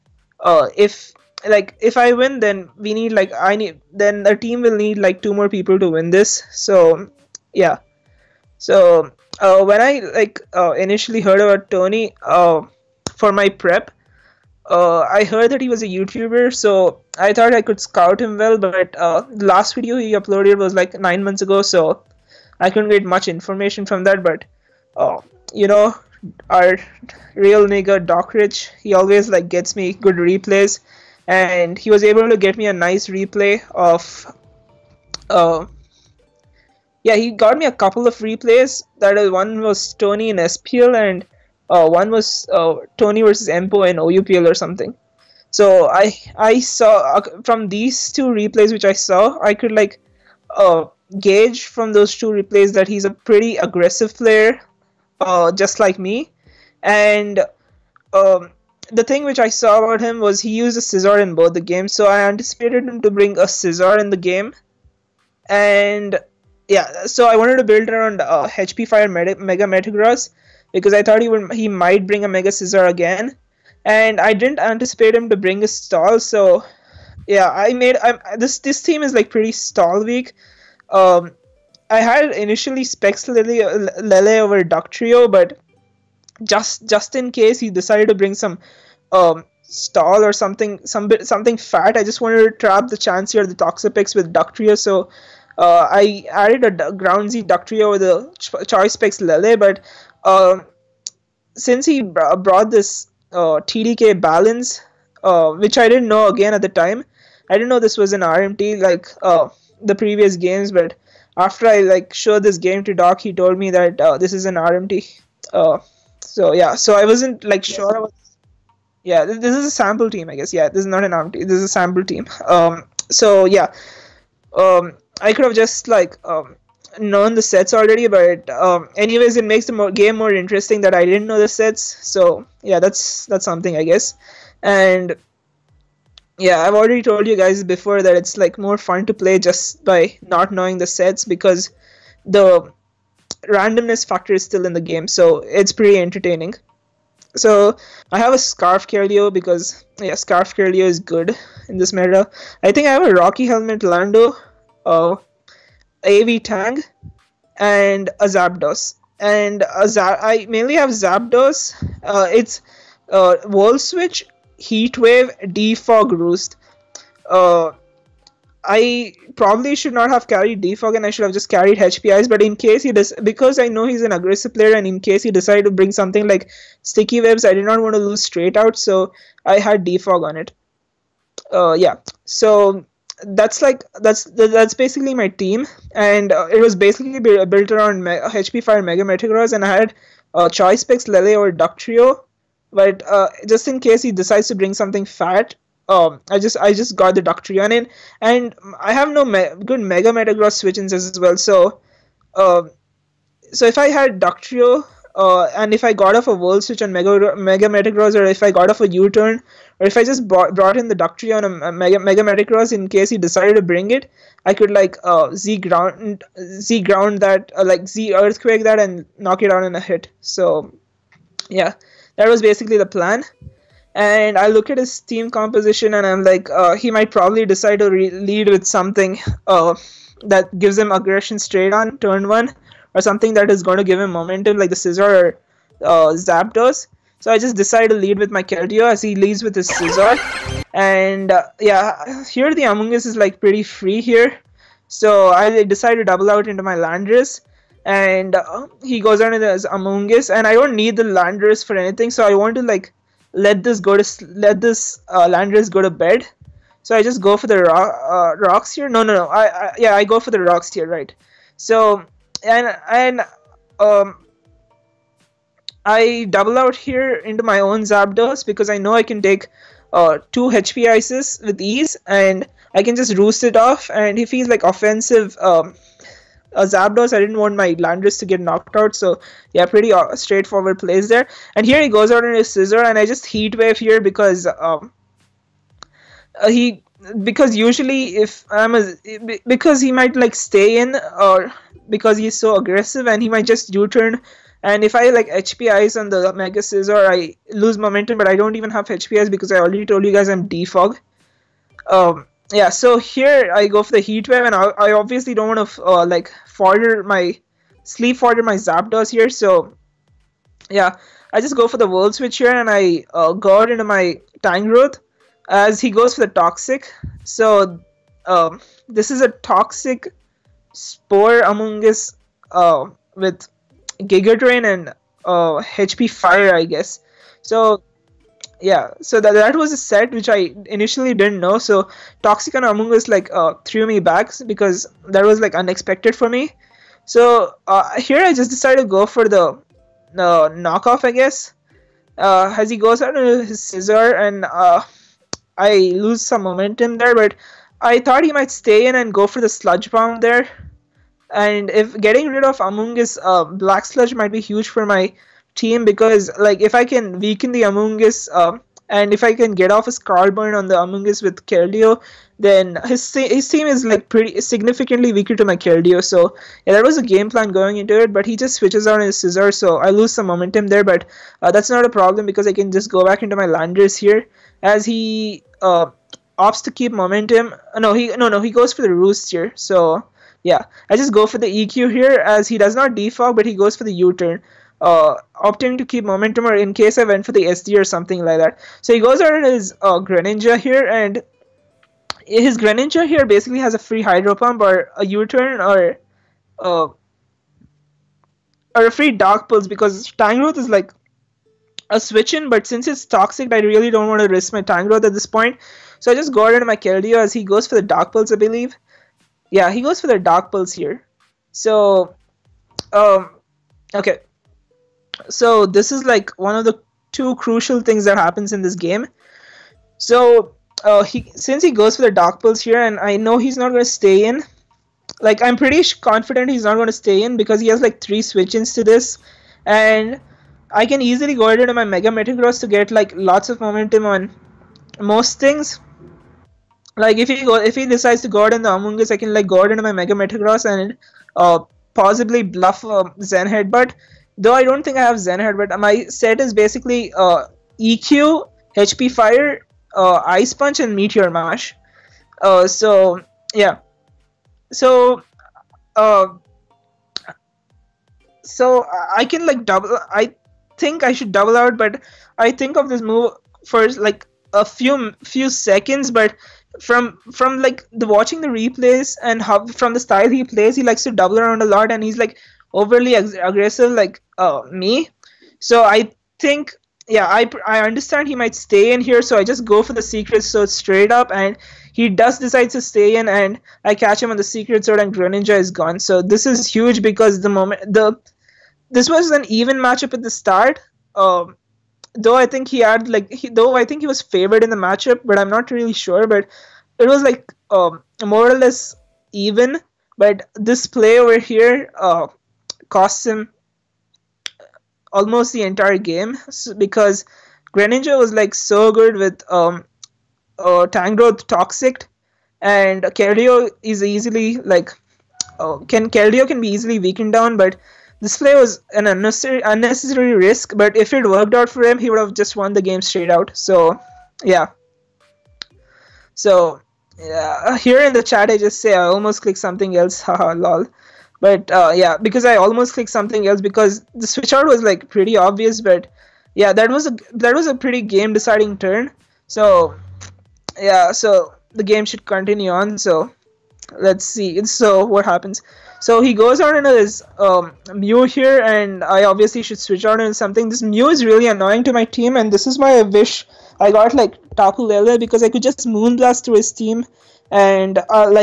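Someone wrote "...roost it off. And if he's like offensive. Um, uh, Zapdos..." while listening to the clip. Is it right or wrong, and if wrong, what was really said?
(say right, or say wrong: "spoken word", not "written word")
right.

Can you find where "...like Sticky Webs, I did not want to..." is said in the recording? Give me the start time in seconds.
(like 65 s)
176 s.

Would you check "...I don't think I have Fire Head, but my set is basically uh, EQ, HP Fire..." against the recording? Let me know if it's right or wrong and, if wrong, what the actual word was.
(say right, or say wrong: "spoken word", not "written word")
wrong: "Zen", not "Fire".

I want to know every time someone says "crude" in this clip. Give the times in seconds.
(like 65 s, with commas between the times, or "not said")
not said.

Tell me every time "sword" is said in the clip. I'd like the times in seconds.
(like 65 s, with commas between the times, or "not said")
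480 s, 484 s.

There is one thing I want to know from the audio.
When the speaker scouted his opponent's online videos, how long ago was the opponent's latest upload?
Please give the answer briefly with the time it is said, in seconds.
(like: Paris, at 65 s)
9 months ago, at 20 s.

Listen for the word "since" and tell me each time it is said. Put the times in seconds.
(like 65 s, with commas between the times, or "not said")
101 s, 402 s, 421 s.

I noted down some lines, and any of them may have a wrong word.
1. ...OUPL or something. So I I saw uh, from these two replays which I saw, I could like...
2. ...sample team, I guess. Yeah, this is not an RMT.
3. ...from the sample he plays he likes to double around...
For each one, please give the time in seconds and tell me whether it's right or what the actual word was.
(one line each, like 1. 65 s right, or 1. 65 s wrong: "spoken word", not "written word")
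1. 43 s right
2. 119 s right
3. 469 s wrong: "style", not "sample".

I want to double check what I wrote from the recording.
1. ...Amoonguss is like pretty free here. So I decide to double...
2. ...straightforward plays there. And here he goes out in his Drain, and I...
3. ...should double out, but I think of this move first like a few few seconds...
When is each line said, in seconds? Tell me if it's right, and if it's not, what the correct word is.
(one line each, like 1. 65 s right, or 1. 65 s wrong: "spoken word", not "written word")
1. 242 s right
2. 280 s wrong: "Scizor", not "Drain"
3. 461 s right.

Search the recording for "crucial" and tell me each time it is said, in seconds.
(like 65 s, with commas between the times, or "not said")
417 s.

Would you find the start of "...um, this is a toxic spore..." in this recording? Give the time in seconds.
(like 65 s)
318 s.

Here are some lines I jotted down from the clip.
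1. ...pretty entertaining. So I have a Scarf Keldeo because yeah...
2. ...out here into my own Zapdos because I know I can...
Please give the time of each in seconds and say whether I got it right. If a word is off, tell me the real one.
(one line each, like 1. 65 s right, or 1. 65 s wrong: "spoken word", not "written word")
1. 145 s right
2. 266 s right.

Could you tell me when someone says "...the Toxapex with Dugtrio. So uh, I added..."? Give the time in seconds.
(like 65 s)
93 s.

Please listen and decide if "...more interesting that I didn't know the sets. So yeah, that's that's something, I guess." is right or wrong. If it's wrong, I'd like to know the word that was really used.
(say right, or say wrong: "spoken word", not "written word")
right.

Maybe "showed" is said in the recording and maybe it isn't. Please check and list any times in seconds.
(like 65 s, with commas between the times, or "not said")
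112 s.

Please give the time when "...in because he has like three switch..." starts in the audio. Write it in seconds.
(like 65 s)
427 s.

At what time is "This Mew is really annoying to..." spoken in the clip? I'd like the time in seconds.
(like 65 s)
550 s.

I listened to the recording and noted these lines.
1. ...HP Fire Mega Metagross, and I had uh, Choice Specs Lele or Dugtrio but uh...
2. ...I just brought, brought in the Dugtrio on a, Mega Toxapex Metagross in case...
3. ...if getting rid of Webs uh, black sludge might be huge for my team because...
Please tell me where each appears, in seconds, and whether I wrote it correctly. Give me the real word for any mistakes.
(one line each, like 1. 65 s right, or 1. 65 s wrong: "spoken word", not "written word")
1. 188 s right
2. 209 s wrong: "Mega", not "Toxapex"
3. 351 s wrong: "Amoonguss", not "Webs".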